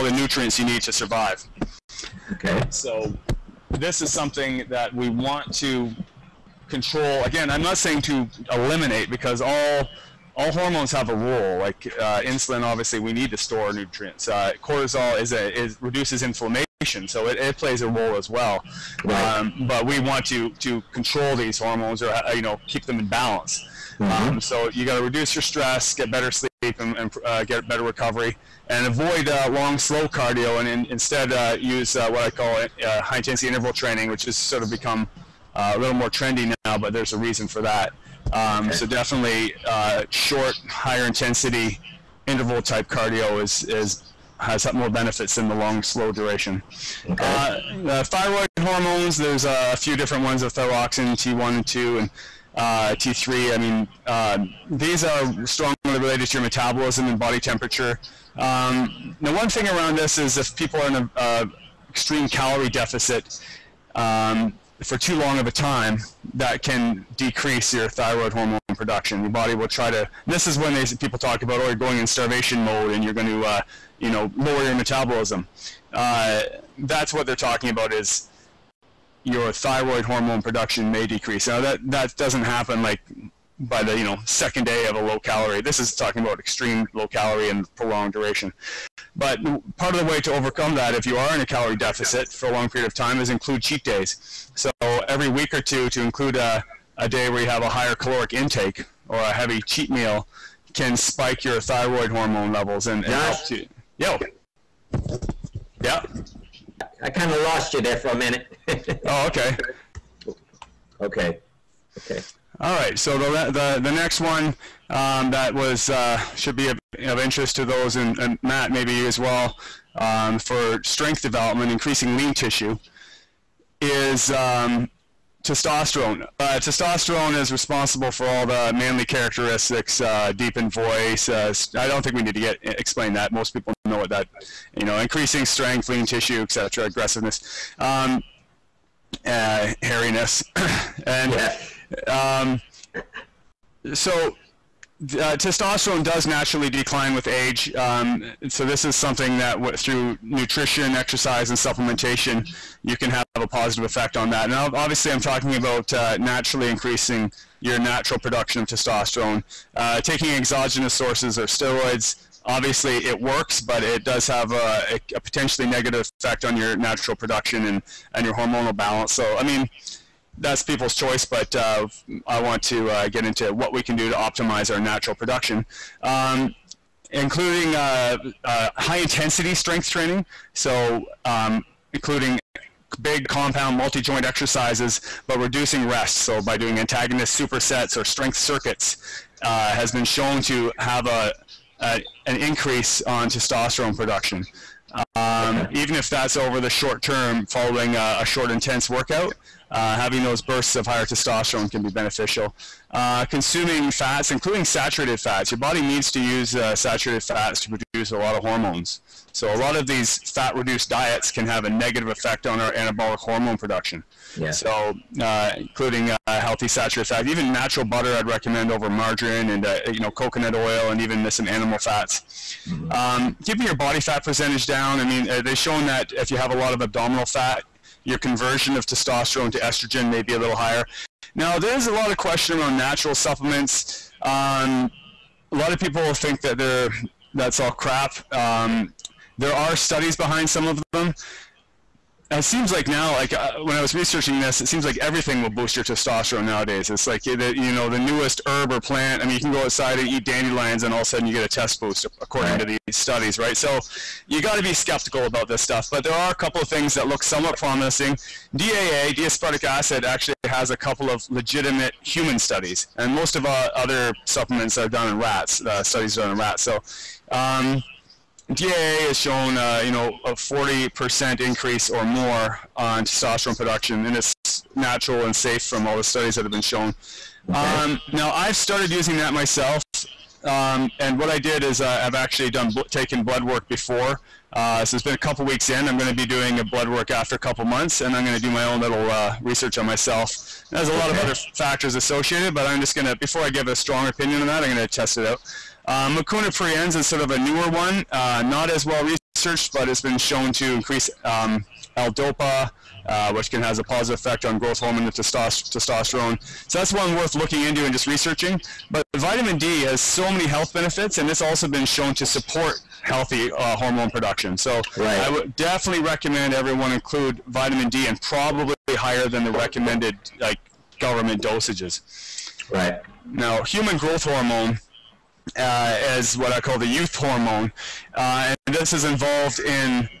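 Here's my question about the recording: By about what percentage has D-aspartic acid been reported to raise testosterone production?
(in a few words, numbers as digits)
40%.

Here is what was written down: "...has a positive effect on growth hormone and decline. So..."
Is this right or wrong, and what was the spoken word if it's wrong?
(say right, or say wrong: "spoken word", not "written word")
wrong: "testosterone", not "decline".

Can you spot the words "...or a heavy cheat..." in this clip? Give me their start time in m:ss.
1:39.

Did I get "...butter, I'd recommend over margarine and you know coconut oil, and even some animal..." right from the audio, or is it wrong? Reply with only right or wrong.
right.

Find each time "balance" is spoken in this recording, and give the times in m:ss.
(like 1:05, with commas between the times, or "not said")
0:23, 2:48.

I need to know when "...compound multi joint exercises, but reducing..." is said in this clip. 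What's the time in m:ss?
3:03.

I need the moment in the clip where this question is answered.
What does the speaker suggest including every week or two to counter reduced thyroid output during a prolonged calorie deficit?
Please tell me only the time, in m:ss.
1:33.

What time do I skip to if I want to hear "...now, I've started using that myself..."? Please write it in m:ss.
4:38.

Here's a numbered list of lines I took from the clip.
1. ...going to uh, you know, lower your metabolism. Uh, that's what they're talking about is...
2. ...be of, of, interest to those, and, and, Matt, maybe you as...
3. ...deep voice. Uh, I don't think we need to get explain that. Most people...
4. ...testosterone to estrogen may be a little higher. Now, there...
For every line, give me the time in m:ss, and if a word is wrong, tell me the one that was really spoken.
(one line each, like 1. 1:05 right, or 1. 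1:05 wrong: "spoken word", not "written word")
1. 1:13 right
2. 1:56 right
3. 2:10 right
4. 3:48 right.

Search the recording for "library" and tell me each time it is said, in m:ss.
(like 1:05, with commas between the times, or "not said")
not said.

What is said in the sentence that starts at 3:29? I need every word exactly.
So a lot of these fat-reduced diets can have a negative effect on our anabolic hormone production.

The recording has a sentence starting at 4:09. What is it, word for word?
I mean, you can go outside and eat dandelions, and all of a sudden you get a test boost, according right.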